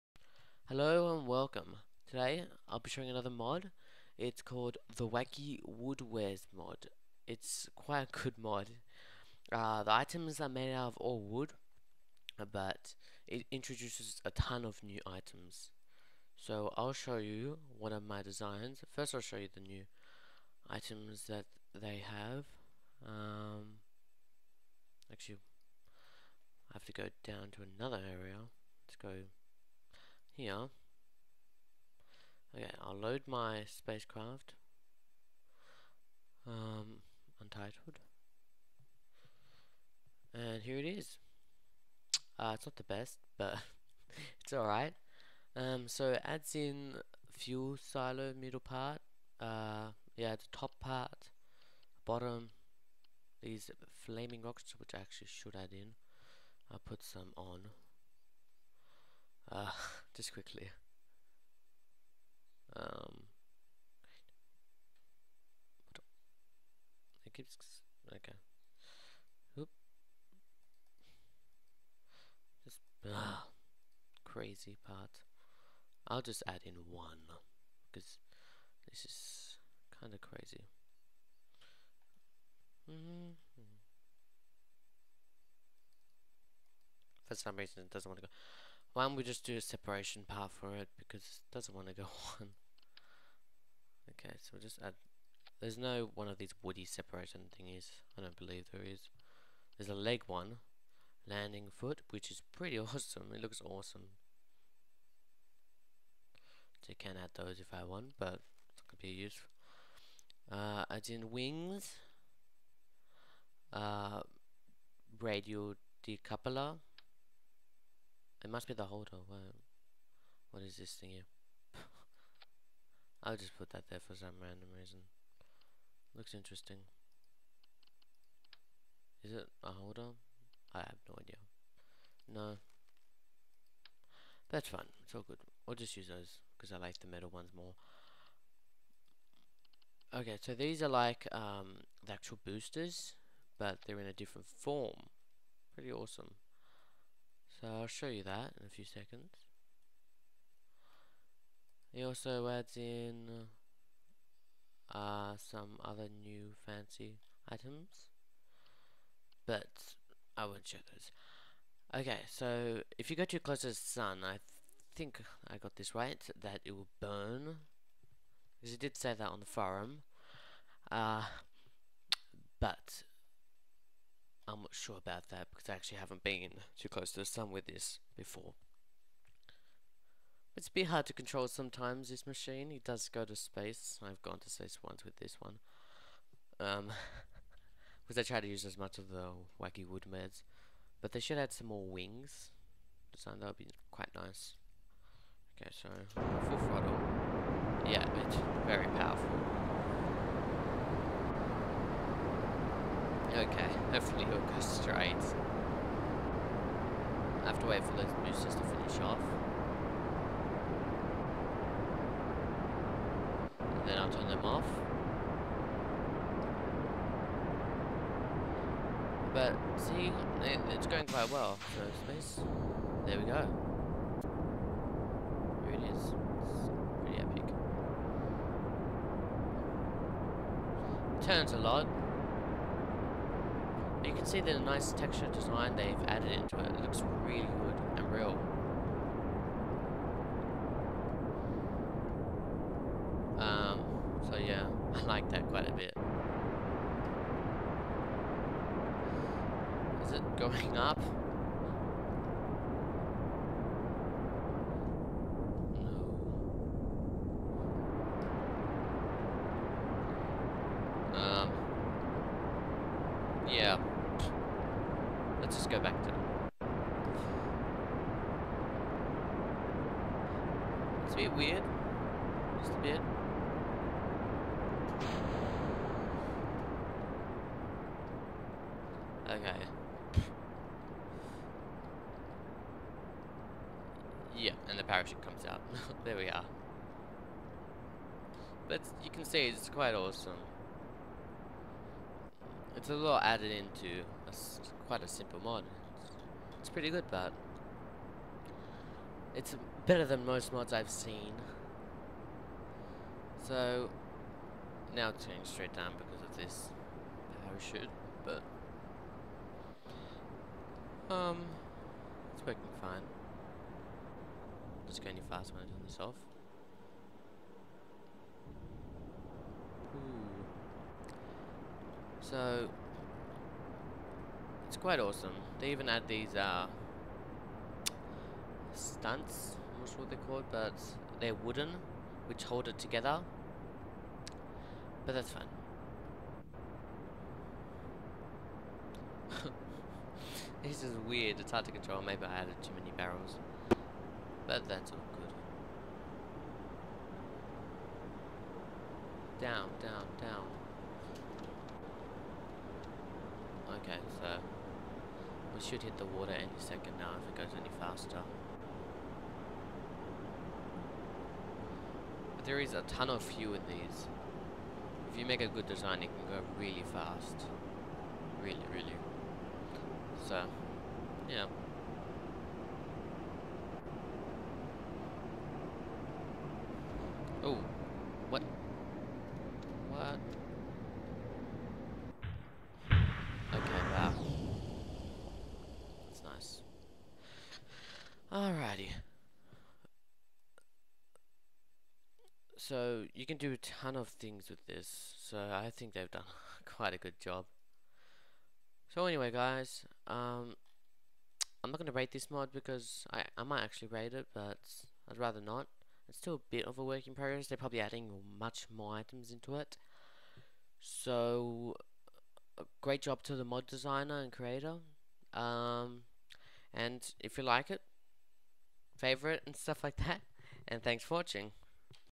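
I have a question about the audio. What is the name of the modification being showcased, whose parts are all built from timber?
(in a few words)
Wacky Wood Wares.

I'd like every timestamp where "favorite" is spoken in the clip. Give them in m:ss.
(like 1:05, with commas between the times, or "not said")
6:58.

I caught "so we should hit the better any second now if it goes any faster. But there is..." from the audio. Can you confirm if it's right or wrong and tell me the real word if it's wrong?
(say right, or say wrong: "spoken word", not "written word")
wrong: "water", not "better".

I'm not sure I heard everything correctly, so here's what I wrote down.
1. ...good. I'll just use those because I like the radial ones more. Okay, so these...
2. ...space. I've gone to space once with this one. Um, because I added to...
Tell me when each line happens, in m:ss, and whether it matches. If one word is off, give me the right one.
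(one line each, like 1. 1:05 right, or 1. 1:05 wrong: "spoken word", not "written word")
1. 2:15 wrong: "metal", not "radial"
2. 3:03 wrong: "tried", not "added".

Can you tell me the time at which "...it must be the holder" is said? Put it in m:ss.
1:58.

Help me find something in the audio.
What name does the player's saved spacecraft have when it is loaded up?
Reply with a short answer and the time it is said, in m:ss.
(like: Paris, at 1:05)
Untitled, at 0:37.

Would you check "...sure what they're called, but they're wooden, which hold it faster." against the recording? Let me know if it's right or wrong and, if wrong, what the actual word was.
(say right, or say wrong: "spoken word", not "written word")
wrong: "together", not "faster".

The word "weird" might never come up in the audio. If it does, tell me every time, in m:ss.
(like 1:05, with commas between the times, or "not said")
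4:31, 5:41.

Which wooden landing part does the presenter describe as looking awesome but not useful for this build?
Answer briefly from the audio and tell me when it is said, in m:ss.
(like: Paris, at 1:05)
Landing foot, at 1:41.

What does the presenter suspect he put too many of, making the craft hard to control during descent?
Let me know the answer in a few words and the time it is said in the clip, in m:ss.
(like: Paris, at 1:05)
Barrels, at 5:42.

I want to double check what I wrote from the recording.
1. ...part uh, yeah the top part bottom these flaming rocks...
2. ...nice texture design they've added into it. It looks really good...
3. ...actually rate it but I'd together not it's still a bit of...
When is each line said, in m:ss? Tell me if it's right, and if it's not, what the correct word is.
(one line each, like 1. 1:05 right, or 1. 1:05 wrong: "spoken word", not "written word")
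1. 0:48 right
2. 3:54 right
3. 6:43 wrong: "rather", not "together".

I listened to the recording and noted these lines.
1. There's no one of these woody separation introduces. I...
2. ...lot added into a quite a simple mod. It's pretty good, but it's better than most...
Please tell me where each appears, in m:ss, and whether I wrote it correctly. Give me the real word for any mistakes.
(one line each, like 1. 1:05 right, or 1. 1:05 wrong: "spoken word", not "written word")
1. 1:35 wrong: "thingies", not "introduces"
2. 4:52 right.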